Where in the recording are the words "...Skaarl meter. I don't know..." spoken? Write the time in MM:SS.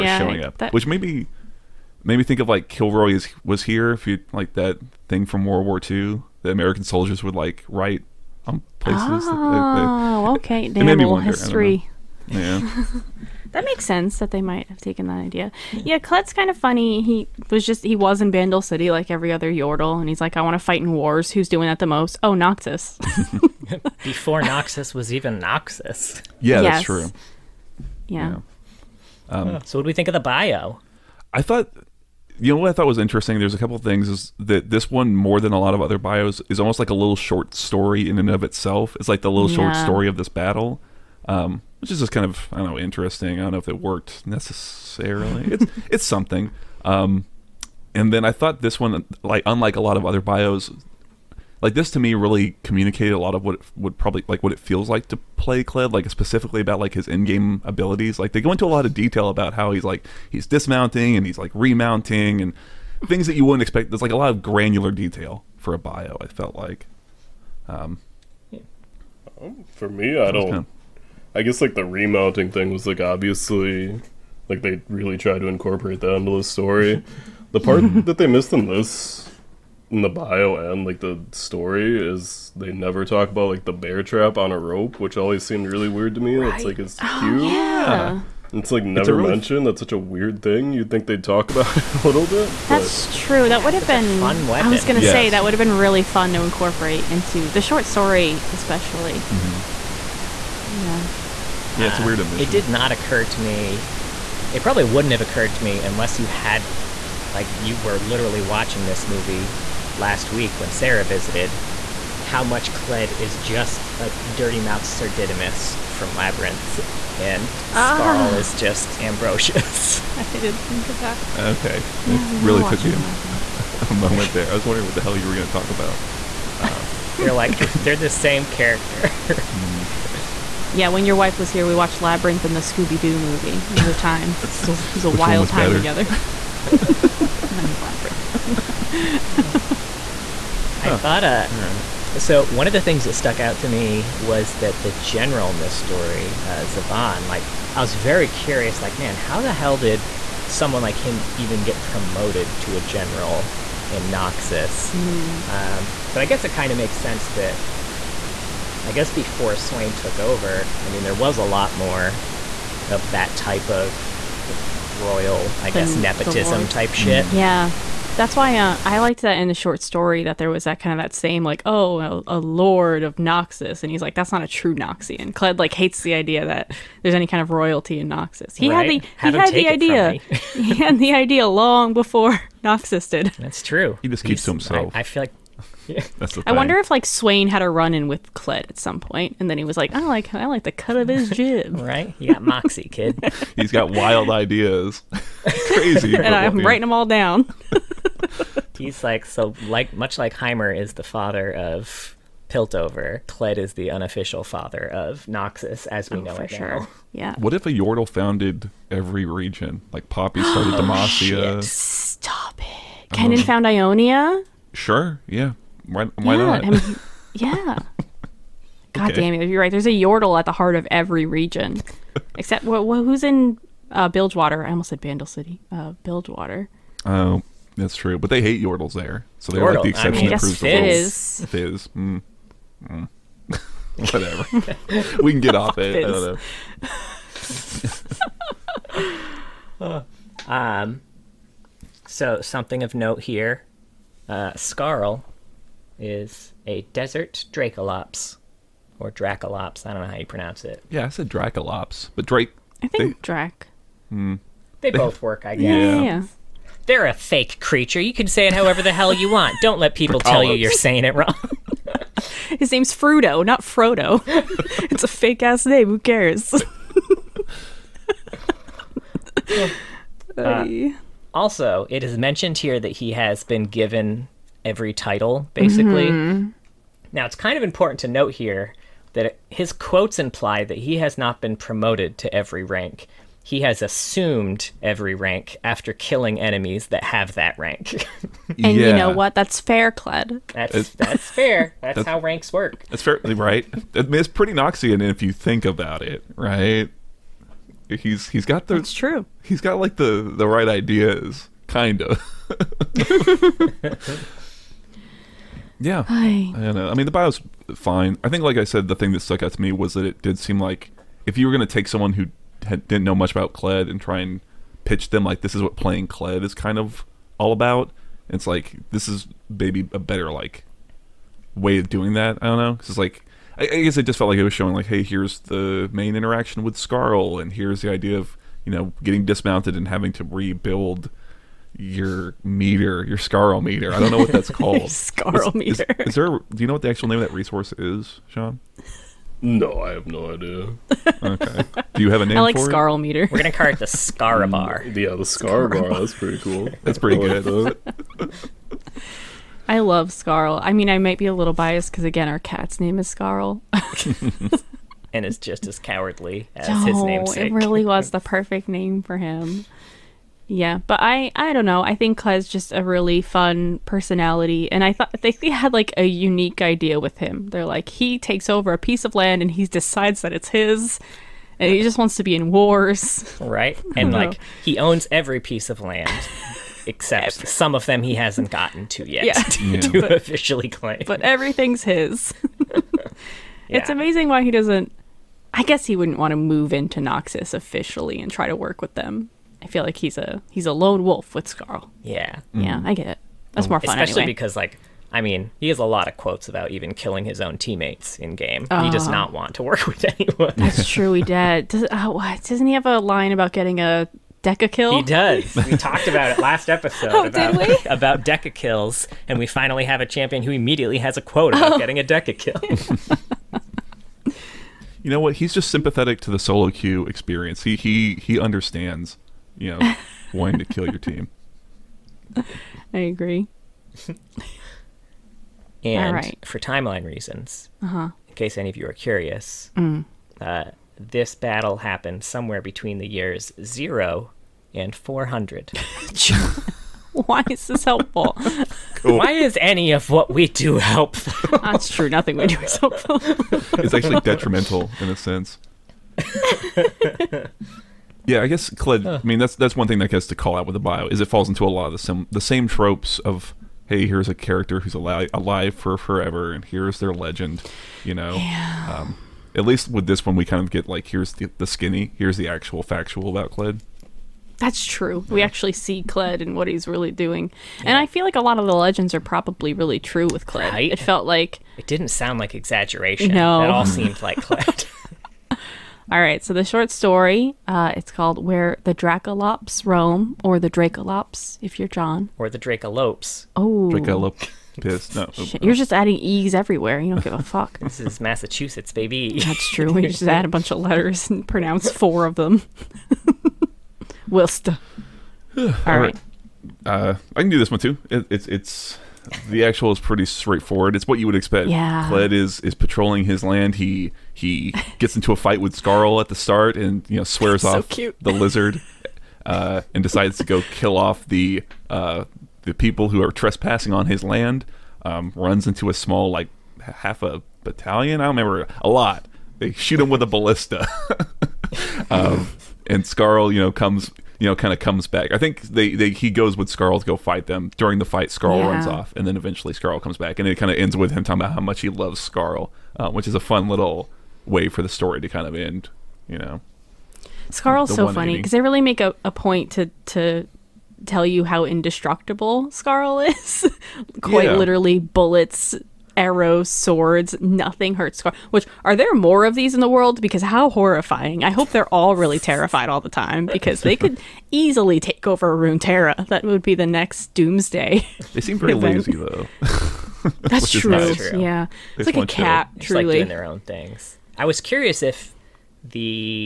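05:33.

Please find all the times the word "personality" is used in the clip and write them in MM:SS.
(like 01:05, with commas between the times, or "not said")
06:03.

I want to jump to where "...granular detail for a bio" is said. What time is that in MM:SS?
01:04.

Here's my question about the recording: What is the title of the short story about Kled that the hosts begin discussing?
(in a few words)
Where the Dracolops Roam.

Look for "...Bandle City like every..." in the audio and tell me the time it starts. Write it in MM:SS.
00:18.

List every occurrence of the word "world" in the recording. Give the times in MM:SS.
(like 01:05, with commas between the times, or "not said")
00:05, 09:09.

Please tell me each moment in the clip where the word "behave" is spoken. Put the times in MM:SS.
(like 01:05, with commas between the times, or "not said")
not said.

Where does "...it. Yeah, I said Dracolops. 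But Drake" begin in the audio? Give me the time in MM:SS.
04:10.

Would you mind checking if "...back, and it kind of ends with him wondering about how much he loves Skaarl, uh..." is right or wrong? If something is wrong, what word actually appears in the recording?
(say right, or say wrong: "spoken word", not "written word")
wrong: "talking", not "wondering".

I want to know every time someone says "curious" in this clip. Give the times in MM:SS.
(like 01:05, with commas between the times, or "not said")
02:28, 07:08, 09:24.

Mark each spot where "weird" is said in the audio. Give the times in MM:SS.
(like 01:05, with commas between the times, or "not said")
01:25, 01:29, 01:42.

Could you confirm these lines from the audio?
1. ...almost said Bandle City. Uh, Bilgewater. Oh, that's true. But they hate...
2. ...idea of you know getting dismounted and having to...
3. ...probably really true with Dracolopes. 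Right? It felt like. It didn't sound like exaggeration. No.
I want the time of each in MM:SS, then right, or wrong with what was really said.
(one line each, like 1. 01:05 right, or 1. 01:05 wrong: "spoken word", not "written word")
1. 03:44 right
2. 05:27 right
3. 07:49 wrong: "Kled", not "Dracolopes".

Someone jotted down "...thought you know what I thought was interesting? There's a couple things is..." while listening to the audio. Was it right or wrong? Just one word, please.
right.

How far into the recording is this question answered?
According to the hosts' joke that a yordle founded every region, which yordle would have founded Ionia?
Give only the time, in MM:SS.
03:33.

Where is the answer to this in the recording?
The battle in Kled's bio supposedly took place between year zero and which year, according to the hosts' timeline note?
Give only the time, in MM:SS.
07:14.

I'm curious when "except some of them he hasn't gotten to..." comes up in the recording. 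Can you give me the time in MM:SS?
06:16.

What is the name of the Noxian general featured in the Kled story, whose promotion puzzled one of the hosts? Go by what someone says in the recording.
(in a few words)
Zaavan.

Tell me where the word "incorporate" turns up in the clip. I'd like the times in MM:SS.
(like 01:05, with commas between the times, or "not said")
01:15, 01:36.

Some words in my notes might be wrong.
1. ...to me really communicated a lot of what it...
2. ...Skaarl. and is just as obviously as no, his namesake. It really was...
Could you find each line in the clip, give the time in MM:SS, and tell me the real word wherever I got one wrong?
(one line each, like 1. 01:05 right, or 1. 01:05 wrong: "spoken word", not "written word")
1. 00:51 right
2. 05:53 wrong: "cowardly", not "obviously".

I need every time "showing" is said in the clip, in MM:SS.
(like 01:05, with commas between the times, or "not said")
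00:00, 05:24.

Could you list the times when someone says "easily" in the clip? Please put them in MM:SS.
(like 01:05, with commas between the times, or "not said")
09:14.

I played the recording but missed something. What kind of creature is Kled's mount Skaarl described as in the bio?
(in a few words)
A desert Dracolops.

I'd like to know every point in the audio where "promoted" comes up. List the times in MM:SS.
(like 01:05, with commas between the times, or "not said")
02:31, 04:41.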